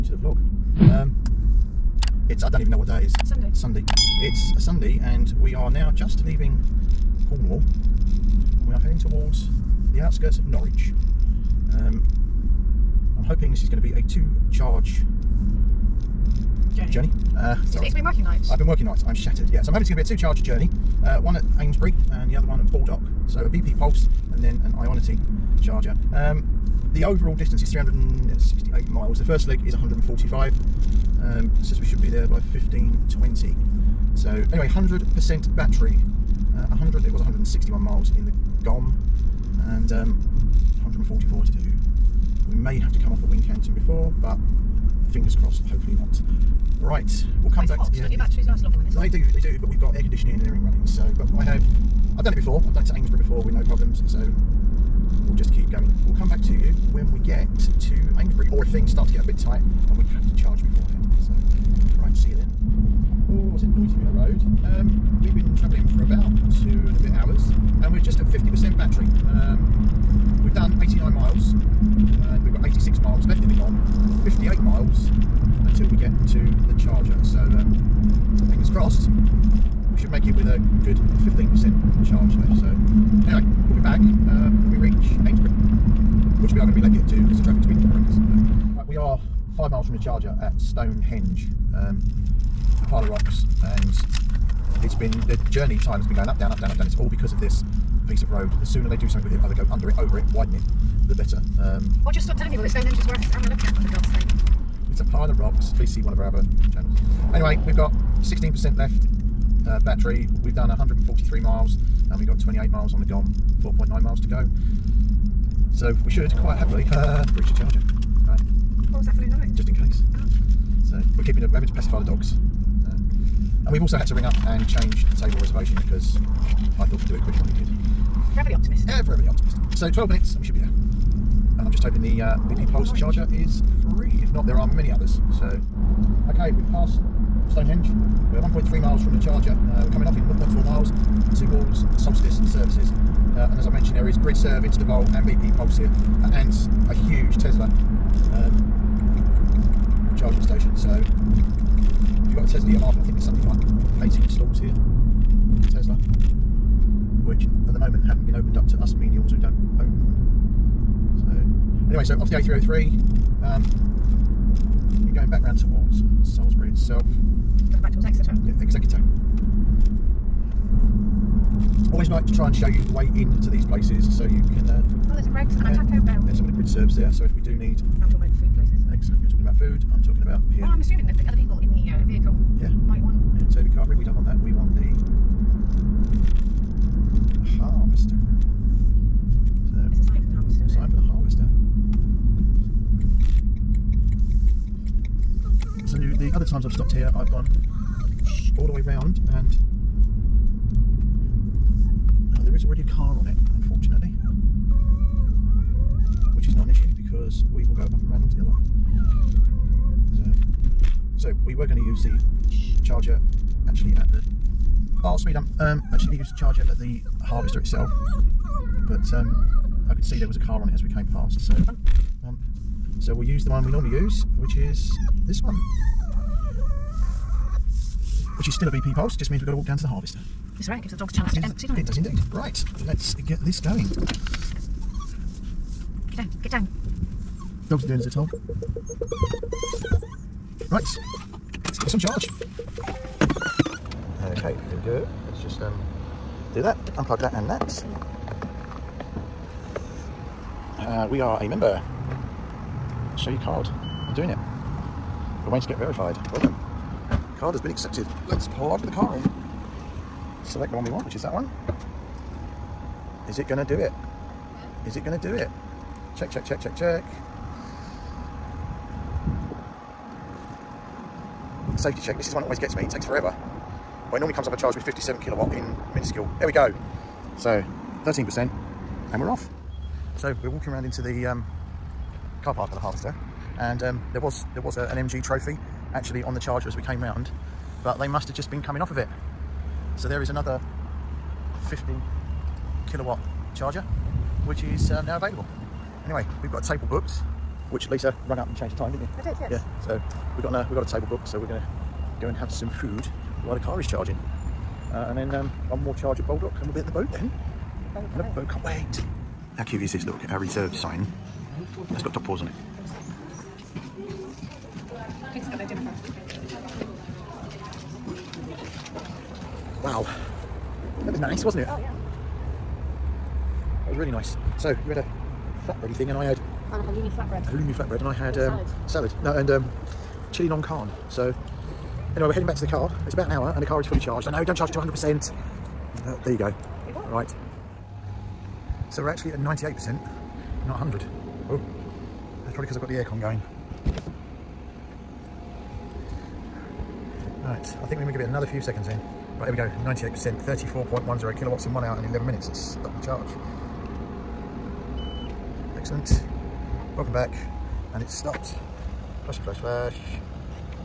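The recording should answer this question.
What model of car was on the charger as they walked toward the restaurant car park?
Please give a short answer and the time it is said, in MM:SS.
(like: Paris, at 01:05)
MG trophy, at 04:45.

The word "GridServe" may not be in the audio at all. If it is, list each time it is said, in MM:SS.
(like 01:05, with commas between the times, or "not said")
02:24, 02:56.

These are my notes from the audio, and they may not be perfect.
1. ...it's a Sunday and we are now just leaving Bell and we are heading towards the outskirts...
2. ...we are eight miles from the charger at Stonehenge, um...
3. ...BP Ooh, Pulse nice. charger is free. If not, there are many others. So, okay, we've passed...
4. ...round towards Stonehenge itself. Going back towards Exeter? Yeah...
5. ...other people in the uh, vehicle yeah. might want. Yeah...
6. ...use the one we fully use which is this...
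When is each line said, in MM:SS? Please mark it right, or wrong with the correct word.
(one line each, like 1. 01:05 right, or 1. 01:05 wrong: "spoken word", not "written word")
1. 00:04 wrong: "Cornwall", not "Bell"
2. 01:28 wrong: "five", not "eight"
3. 02:12 right
4. 02:45 wrong: "Salisbury", not "Stonehenge"
5. 03:01 right
6. 03:43 wrong: "normally", not "fully".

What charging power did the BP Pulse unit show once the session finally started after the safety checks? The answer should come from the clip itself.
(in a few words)
57 kilowatts.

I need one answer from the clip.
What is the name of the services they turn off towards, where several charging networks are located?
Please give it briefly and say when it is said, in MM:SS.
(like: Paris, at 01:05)
Solstice Services, at 02:21.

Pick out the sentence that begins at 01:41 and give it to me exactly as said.
Um, or just stop telling people that Stonehenge is worth having a look at, for God's sake.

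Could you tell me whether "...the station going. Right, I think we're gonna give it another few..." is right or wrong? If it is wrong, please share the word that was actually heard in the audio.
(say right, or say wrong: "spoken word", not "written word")
wrong: "aircon", not "station".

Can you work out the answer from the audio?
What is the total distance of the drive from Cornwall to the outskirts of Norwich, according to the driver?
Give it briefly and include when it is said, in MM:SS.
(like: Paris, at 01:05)
368 miles, at 00:27.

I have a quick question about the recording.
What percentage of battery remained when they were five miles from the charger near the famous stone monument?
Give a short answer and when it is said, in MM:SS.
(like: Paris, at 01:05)
16%, at 01:48.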